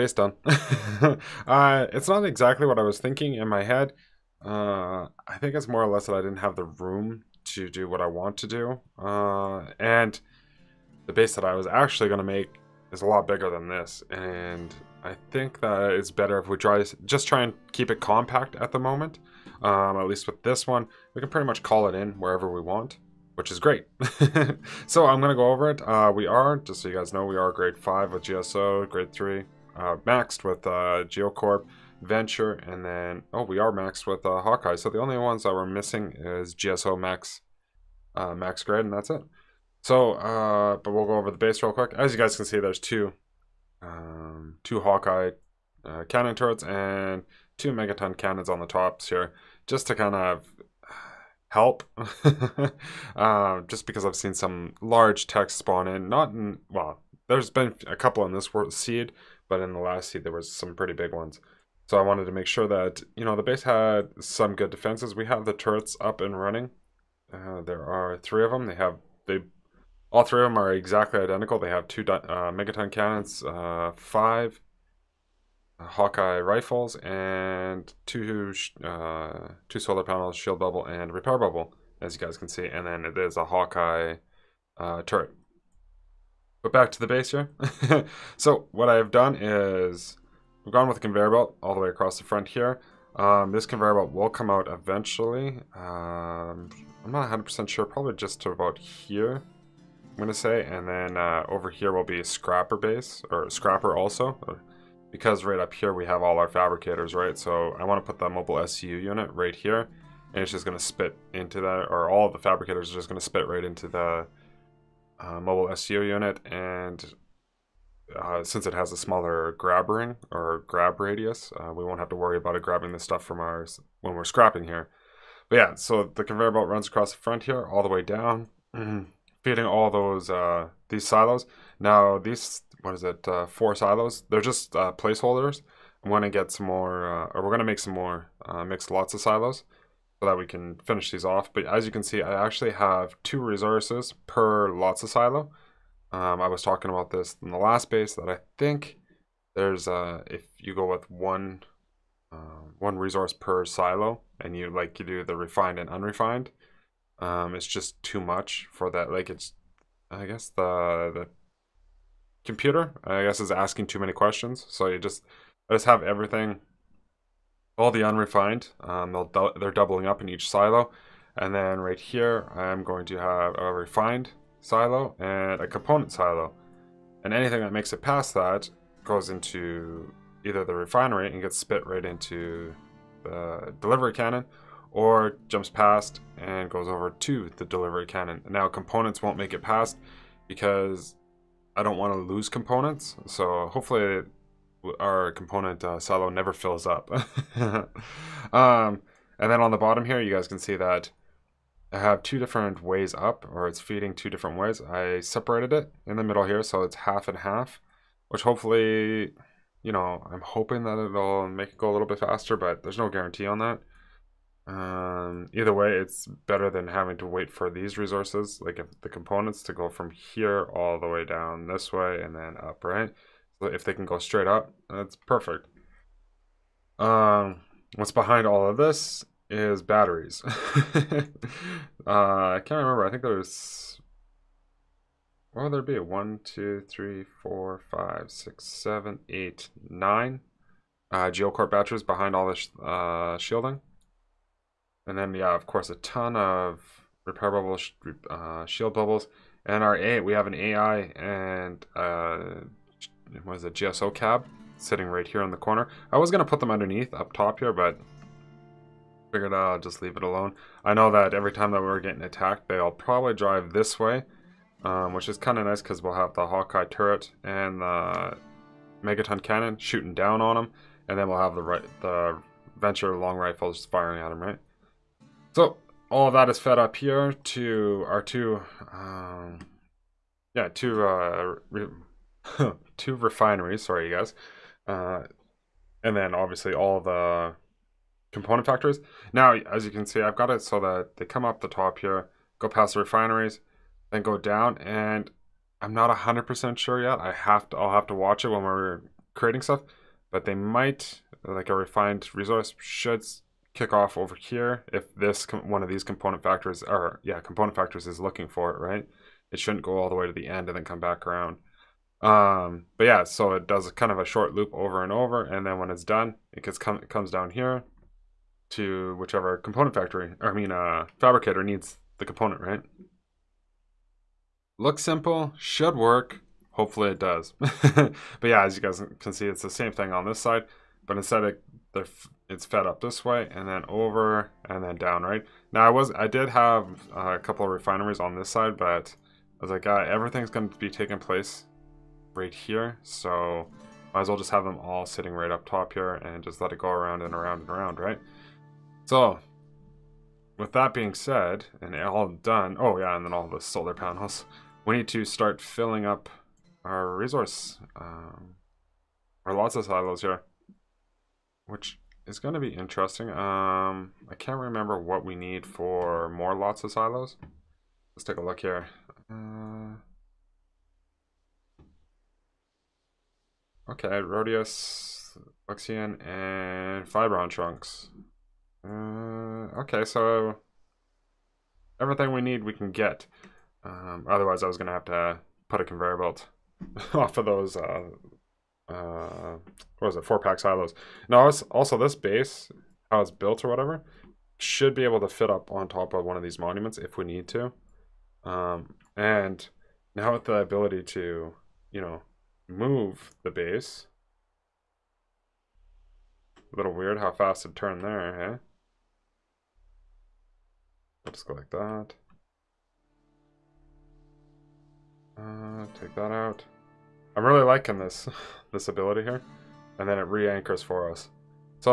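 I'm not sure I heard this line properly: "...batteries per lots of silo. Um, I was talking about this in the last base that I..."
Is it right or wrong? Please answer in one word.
wrong.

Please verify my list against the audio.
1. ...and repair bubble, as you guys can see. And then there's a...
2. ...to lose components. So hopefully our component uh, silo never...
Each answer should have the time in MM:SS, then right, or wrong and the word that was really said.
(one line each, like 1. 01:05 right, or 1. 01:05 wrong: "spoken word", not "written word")
1. 01:20 right
2. 03:12 right.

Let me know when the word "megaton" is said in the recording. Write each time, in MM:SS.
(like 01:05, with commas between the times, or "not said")
00:47, 01:12, 04:29.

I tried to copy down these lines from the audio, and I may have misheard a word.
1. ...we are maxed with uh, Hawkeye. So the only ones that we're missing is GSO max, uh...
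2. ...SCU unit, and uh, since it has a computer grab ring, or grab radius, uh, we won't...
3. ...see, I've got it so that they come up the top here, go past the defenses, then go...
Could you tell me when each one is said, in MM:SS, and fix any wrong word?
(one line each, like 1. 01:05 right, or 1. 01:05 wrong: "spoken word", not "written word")
1. 00:33 right
2. 01:55 wrong: "smaller", not "computer"
3. 04:50 wrong: "refineries", not "defenses".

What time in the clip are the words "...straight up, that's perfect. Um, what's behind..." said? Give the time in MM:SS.
03:44.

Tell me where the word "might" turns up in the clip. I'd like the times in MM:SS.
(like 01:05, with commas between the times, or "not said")
05:00, 05:44.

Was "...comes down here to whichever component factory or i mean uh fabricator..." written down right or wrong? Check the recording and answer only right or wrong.
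right.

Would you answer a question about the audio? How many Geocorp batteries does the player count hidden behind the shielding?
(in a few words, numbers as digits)
9.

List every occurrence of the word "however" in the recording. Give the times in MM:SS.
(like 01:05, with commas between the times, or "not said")
not said.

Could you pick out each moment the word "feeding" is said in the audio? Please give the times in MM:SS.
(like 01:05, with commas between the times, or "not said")
02:09, 03:23.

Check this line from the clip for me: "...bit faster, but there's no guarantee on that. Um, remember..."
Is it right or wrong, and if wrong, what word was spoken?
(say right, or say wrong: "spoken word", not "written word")
wrong: "either", not "remember".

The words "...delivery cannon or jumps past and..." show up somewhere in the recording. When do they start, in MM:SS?
03:03.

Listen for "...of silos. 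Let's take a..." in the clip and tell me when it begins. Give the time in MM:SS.
06:06.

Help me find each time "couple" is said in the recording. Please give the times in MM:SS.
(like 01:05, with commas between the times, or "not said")
00:57, 05:37.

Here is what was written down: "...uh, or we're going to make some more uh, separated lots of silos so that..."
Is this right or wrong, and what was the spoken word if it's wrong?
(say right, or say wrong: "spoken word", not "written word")
wrong: "mixed", not "separated".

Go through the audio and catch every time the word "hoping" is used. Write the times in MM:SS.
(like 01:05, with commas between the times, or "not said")
03:30.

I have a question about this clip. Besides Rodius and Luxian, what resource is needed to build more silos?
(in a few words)
Fibron Trunks.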